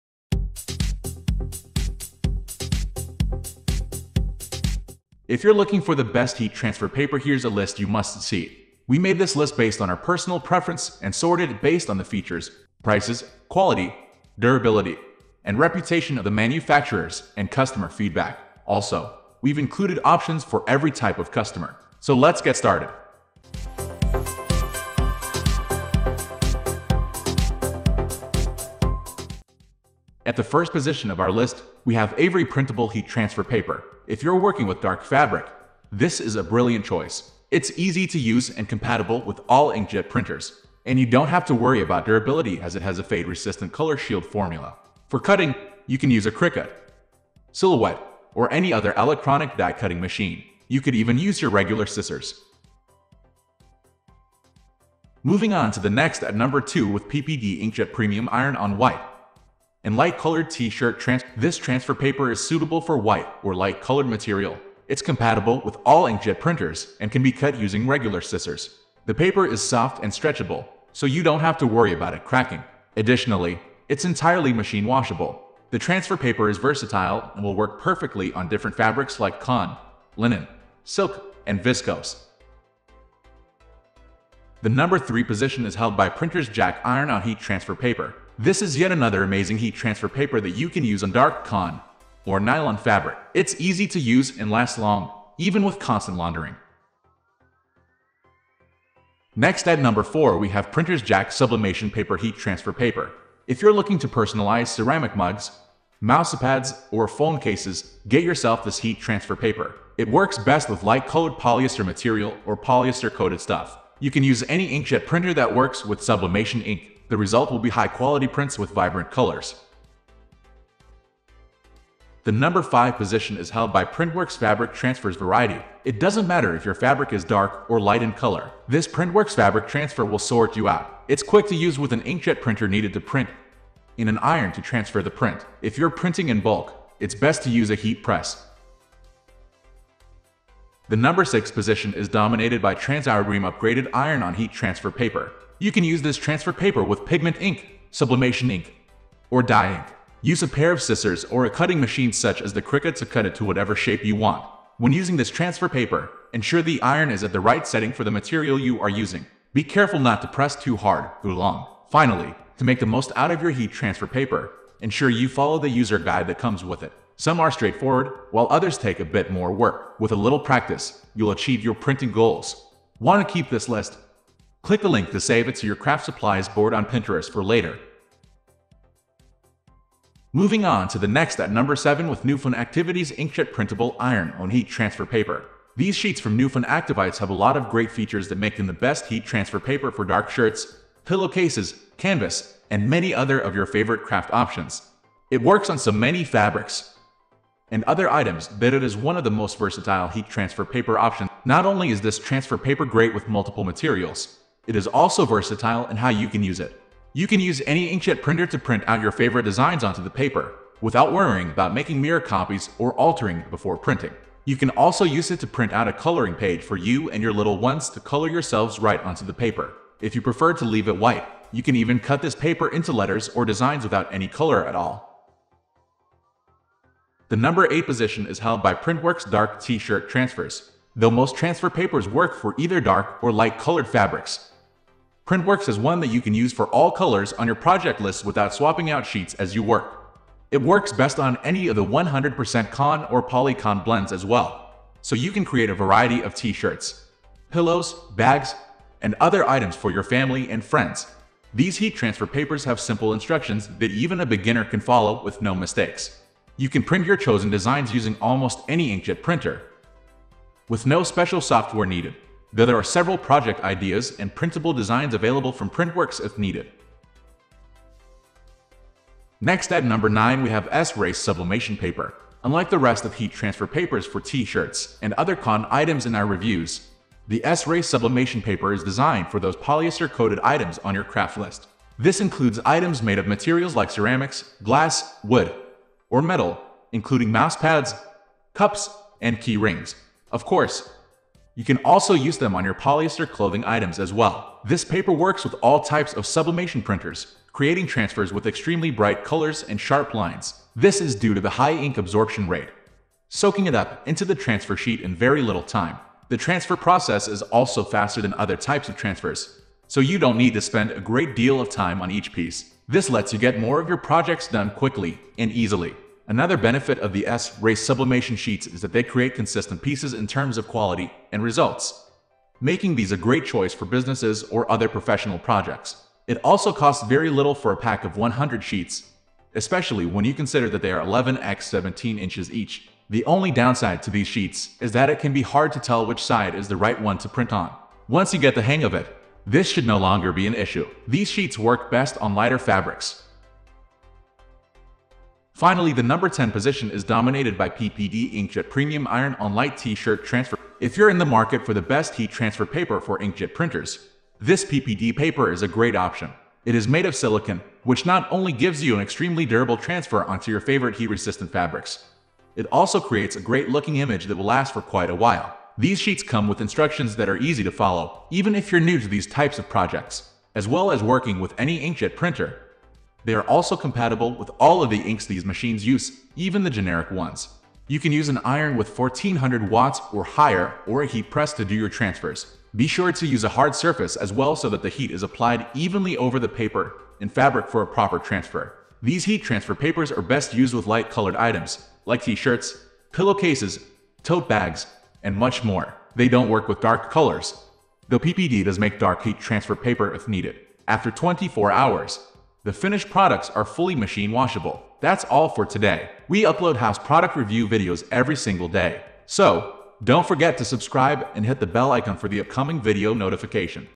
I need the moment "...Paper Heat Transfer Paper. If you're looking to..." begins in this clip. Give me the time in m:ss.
1:41.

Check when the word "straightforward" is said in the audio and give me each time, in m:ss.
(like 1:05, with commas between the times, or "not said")
2:47.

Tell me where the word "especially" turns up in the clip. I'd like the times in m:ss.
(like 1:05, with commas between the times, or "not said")
5:29.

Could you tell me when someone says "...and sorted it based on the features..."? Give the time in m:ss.
0:11.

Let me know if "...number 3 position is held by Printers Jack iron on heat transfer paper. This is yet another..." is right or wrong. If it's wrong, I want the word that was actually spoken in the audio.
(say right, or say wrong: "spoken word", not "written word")
right.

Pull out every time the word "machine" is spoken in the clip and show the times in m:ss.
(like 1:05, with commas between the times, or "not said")
0:49, 1:14, 2:31, 6:15, 6:43.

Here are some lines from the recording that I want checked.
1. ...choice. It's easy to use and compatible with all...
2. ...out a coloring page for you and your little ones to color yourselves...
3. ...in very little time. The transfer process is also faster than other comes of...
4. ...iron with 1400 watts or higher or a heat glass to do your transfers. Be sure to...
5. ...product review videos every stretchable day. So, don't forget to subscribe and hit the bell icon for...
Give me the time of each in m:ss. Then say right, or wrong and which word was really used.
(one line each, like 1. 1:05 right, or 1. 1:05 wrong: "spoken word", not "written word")
1. 0:36 right
2. 3:35 right
3. 5:05 wrong: "types", not "comes"
4. 6:18 wrong: "press", not "glass"
5. 6:46 wrong: "single", not "stretchable".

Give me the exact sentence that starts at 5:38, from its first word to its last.
Once you get the hang of it, this should no longer be an issue.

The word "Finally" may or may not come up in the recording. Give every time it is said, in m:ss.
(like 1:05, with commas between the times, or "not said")
2:41, 5:45.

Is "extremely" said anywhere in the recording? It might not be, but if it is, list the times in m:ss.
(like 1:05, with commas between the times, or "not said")
4:58, 5:59.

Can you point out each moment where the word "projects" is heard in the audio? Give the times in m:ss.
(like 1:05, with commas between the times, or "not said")
3:57, 4:23, 5:13, 5:25, 6:09.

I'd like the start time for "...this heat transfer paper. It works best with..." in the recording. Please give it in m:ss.
1:48.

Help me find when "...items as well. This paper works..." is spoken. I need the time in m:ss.
4:53.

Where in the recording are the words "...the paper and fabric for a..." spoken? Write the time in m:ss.
6:26.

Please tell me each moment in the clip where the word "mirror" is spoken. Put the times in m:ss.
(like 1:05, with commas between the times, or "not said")
3:32.